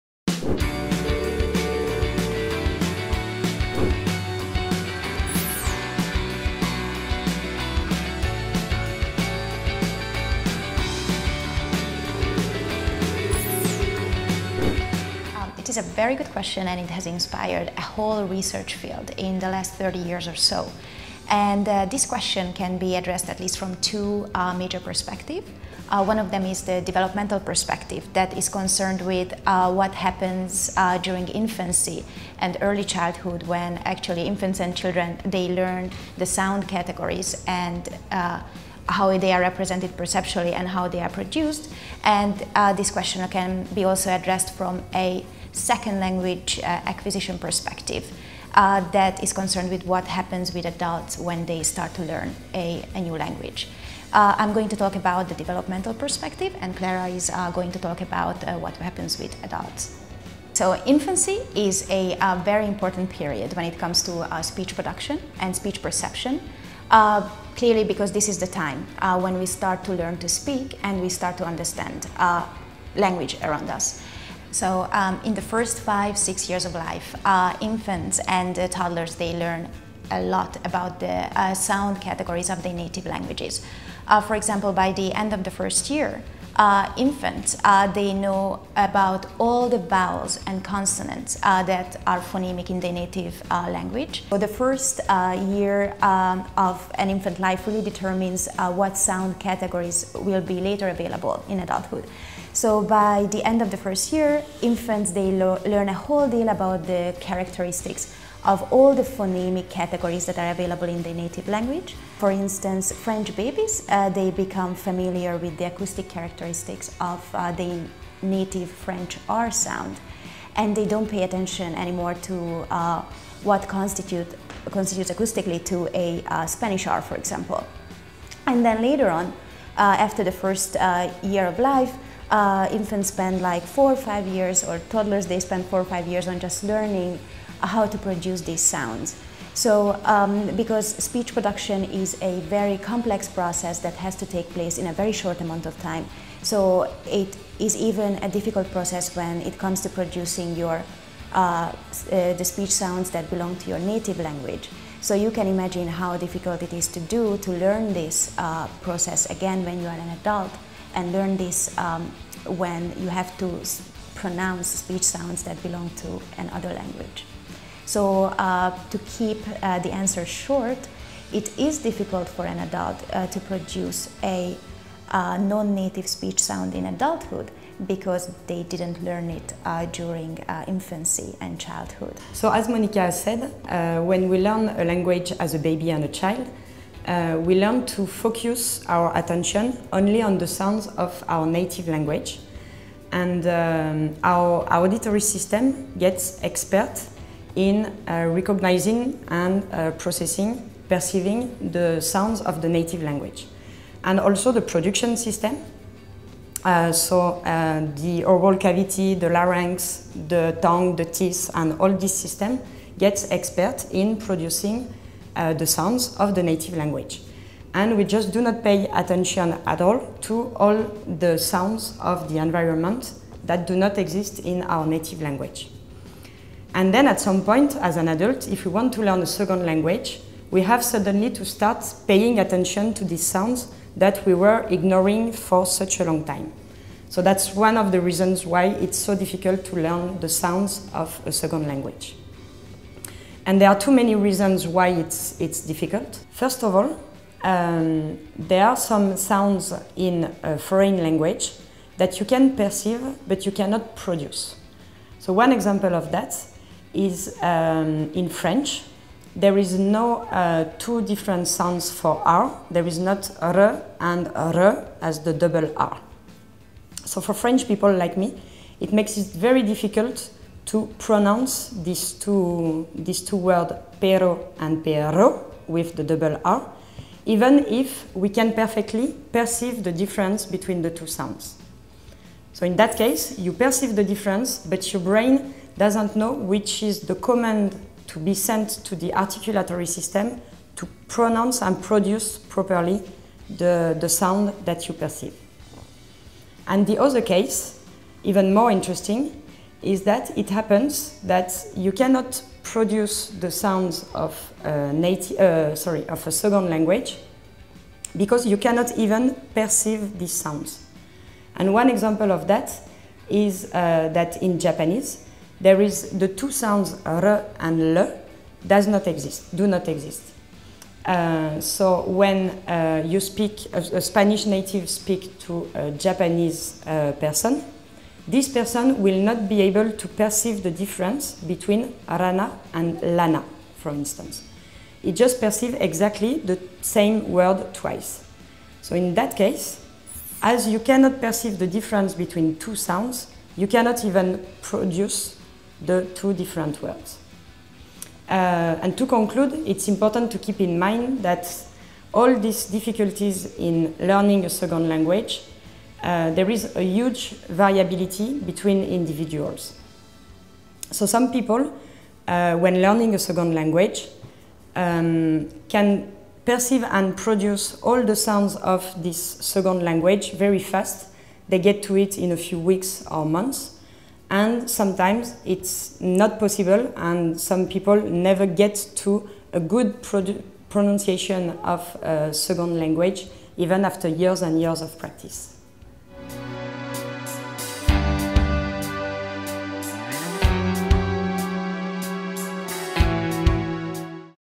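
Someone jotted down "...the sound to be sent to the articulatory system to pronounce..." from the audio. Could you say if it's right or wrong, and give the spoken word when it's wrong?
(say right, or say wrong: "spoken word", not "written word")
wrong: "command", not "sound".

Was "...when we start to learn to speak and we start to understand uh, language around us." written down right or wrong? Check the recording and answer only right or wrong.
right.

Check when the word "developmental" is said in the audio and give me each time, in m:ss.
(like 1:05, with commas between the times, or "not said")
0:26, 0:55.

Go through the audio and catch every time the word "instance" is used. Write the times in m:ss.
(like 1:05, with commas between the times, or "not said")
1:52, 5:33.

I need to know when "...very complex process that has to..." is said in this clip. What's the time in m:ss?
2:22.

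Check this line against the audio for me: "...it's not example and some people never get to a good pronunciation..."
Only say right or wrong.
wrong.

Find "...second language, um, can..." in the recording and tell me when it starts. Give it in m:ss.
6:03.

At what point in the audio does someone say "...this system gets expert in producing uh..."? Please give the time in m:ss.
3:31.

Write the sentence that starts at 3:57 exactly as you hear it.
So that's one of the reasons why it's so difficult to learn the sounds of a second language.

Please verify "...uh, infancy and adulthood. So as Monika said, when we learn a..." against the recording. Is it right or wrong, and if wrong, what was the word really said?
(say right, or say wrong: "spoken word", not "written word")
wrong: "childhood", not "adulthood".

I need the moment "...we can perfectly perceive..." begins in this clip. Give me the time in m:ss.
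4:38.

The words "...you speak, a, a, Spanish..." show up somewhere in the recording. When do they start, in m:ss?
5:23.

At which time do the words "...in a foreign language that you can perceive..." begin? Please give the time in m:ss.
4:09.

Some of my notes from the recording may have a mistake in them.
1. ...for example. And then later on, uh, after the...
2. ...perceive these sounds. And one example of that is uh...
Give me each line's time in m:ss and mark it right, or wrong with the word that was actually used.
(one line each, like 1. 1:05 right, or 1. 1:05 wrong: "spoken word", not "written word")
1. 2:07 right
2. 5:09 right.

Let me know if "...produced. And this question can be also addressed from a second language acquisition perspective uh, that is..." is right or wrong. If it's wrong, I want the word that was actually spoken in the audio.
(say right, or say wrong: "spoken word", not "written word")
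right.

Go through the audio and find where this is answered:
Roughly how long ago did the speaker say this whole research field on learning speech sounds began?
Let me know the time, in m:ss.
0:19.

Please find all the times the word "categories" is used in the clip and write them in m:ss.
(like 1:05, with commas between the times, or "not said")
0:36, 1:22, 1:39, 1:49.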